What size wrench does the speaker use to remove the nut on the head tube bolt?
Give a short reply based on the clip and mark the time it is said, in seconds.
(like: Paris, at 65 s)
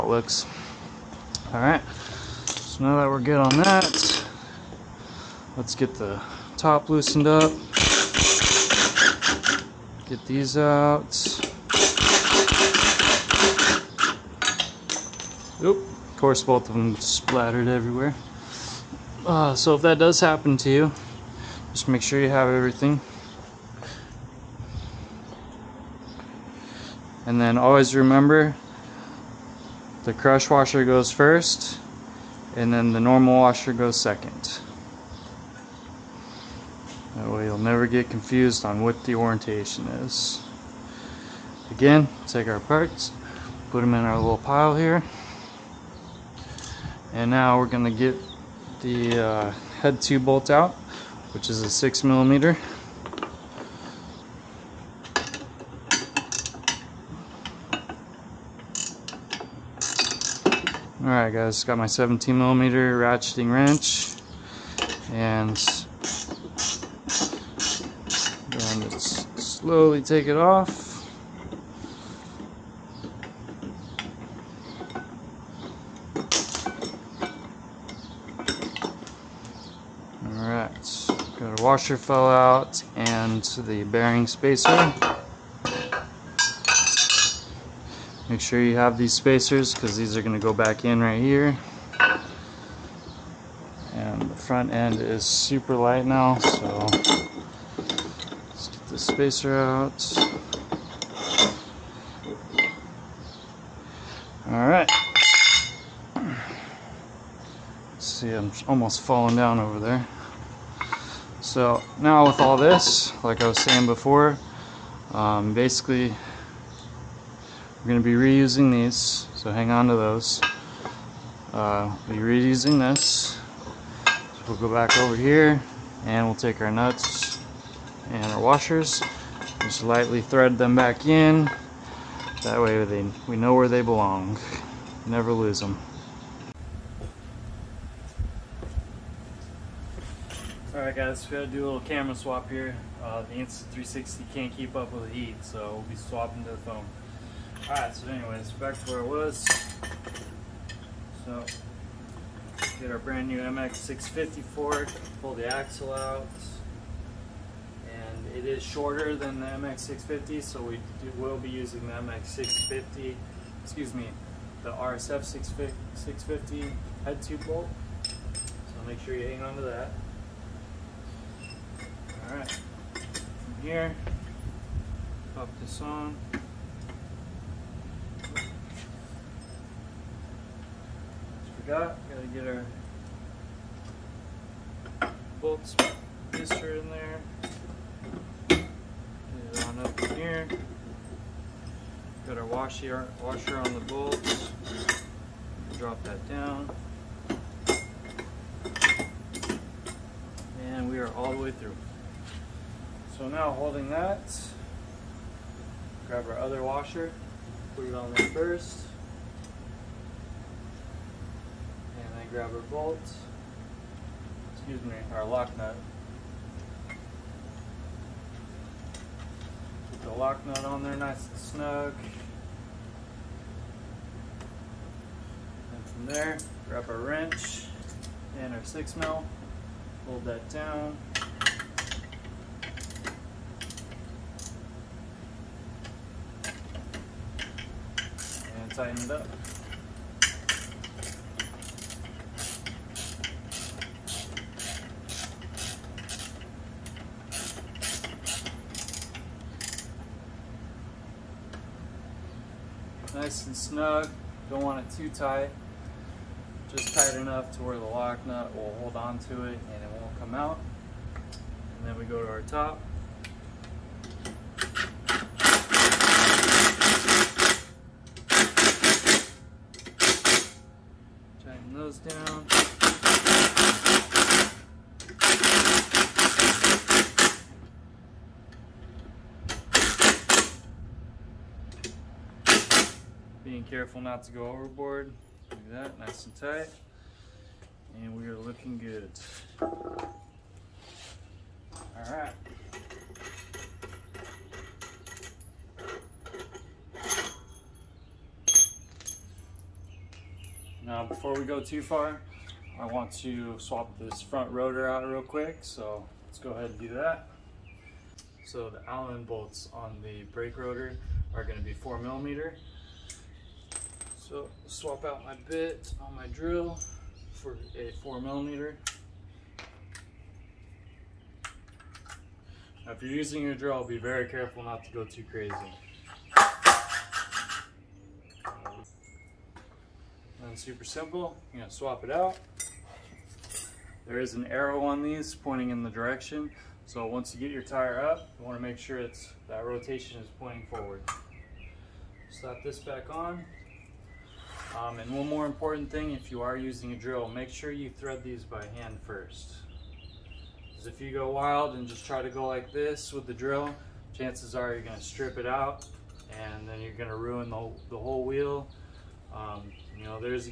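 17 millimeter, at 61 s.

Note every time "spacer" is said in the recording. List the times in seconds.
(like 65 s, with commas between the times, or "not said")
84 s, 89 s, 99 s.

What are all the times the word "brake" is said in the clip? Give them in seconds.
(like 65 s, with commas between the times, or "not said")
310 s.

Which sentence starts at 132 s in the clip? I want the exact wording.
That way they, we know where they belong.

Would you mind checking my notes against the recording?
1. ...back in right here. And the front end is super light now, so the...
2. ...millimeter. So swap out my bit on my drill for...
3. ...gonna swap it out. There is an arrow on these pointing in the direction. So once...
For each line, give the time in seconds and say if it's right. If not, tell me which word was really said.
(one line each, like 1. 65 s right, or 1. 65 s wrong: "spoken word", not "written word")
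1. 90 s right
2. 311 s right
3. 331 s right.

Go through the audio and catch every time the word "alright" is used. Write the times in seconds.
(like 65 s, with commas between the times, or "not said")
1 s, 61 s, 80 s, 140 s, 147 s.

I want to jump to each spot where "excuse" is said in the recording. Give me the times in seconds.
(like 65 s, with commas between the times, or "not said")
163 s, 214 s.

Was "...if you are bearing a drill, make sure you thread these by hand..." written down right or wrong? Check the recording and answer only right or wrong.
wrong.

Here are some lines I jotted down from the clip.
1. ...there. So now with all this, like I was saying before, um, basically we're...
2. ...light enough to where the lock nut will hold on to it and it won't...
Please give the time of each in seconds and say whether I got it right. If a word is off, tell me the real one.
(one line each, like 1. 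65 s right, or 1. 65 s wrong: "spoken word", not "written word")
1. 109 s right
2. 256 s wrong: "tight", not "light".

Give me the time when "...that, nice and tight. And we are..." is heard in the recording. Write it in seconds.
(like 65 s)
285 s.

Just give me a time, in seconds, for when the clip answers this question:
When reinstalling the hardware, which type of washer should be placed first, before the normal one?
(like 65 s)
30 s.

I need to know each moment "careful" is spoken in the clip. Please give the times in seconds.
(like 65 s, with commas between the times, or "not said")
283 s, 324 s.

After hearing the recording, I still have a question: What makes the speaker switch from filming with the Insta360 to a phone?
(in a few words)
The heat.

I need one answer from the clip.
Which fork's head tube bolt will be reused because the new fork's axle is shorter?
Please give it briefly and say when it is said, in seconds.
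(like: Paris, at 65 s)
RSF 650, at 164 s.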